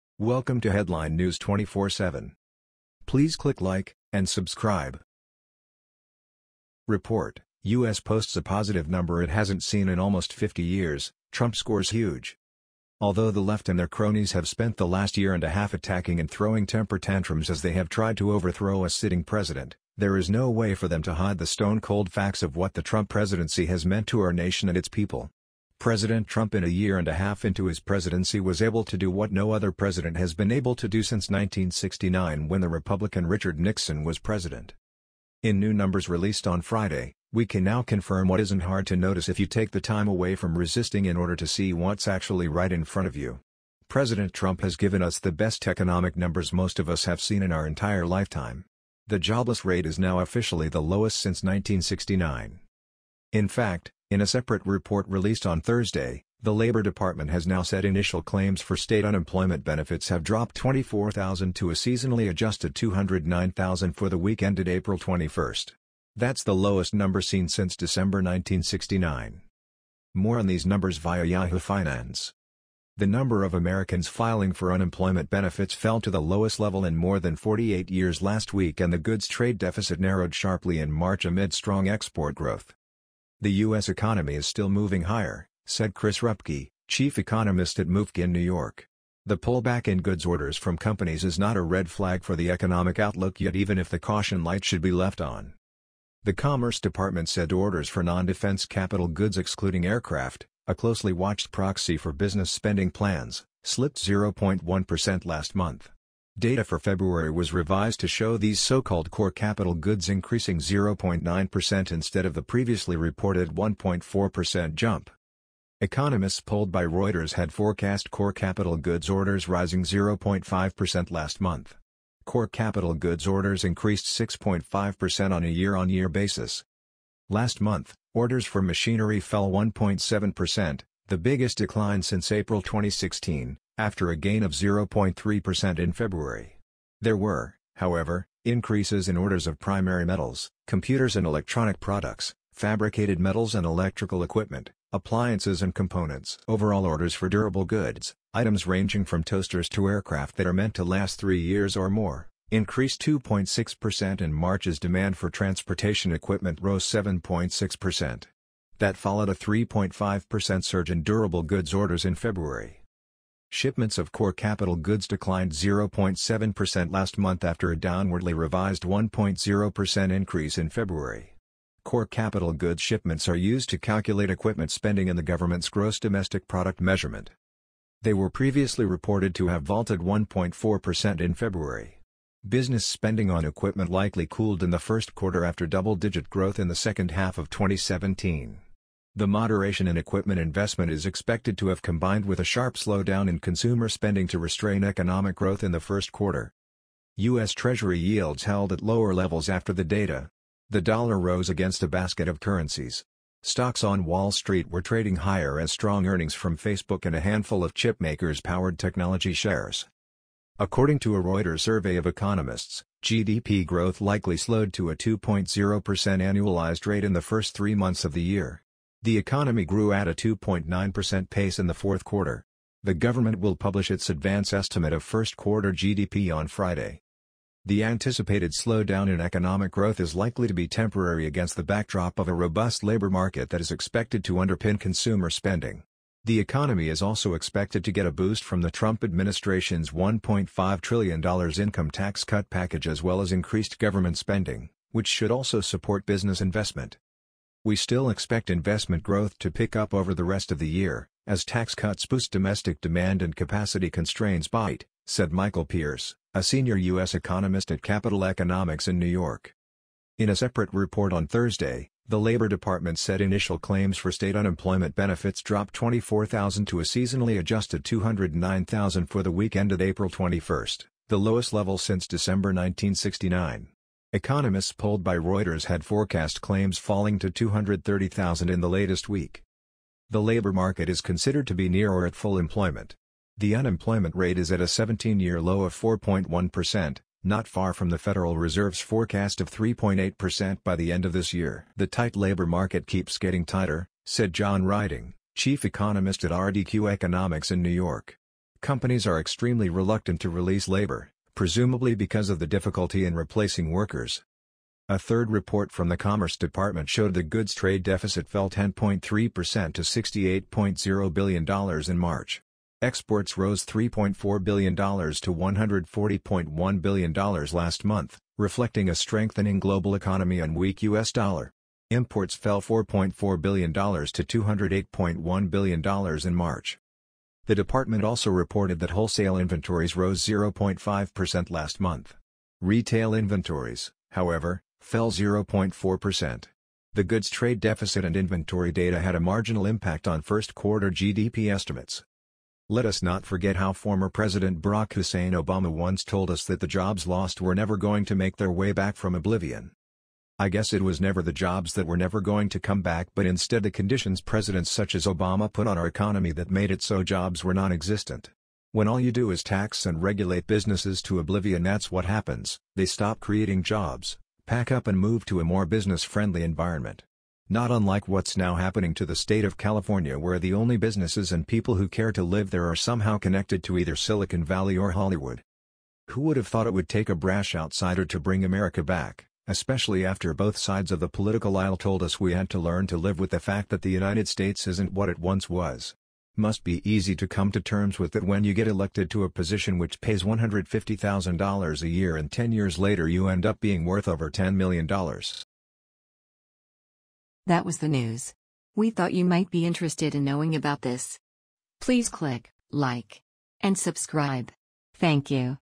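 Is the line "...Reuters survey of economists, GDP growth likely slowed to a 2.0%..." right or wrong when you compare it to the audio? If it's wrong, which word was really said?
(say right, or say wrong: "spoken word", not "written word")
right.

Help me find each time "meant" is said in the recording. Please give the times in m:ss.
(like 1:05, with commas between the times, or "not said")
0:23, 2:30.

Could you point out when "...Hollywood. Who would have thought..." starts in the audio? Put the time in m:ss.
6:14.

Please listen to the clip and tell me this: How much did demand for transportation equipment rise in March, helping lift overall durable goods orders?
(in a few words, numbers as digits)
7.6%.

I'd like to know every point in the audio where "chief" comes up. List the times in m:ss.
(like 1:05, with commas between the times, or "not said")
1:26, 4:55.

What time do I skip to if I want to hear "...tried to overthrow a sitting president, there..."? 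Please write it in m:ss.
0:17.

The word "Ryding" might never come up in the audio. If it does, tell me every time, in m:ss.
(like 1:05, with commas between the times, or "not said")
4:54.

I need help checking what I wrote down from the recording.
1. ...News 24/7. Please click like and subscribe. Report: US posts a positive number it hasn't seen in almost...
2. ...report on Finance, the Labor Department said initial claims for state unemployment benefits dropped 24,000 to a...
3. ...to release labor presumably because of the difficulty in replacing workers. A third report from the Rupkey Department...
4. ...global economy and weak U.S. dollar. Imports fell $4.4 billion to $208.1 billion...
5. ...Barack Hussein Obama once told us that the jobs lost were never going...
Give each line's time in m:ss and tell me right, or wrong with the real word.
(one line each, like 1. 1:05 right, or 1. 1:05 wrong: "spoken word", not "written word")
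1. 0:01 right
2. 4:20 wrong: "Thursday", not "Finance"
3. 5:00 wrong: "Commerce", not "Rupkey"
4. 5:19 right
5. 5:44 right.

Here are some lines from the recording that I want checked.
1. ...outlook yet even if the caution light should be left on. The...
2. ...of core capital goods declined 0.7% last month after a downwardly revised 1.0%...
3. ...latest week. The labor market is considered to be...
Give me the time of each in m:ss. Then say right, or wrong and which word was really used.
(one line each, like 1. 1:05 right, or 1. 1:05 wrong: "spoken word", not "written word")
1. 1:32 right
2. 2:43 right
3. 4:38 right.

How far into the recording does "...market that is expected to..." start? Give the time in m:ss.
3:53.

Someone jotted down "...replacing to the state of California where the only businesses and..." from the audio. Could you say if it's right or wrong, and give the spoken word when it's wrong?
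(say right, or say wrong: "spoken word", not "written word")
wrong: "happening", not "replacing".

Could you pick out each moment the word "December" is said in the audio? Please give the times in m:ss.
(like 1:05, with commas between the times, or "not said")
1:07, 4:32.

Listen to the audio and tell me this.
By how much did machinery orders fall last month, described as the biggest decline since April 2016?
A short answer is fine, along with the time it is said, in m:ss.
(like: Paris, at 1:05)
1.7%, at 2:09.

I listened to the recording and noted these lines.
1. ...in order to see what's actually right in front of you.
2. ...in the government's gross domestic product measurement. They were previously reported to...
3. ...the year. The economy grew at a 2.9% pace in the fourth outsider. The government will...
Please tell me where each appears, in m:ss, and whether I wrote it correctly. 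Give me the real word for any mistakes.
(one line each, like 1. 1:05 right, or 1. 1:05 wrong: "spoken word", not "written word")
1. 0:41 right
2. 2:55 right
3. 3:38 wrong: "quarter", not "outsider".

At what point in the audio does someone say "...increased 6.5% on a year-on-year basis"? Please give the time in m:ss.
2:03.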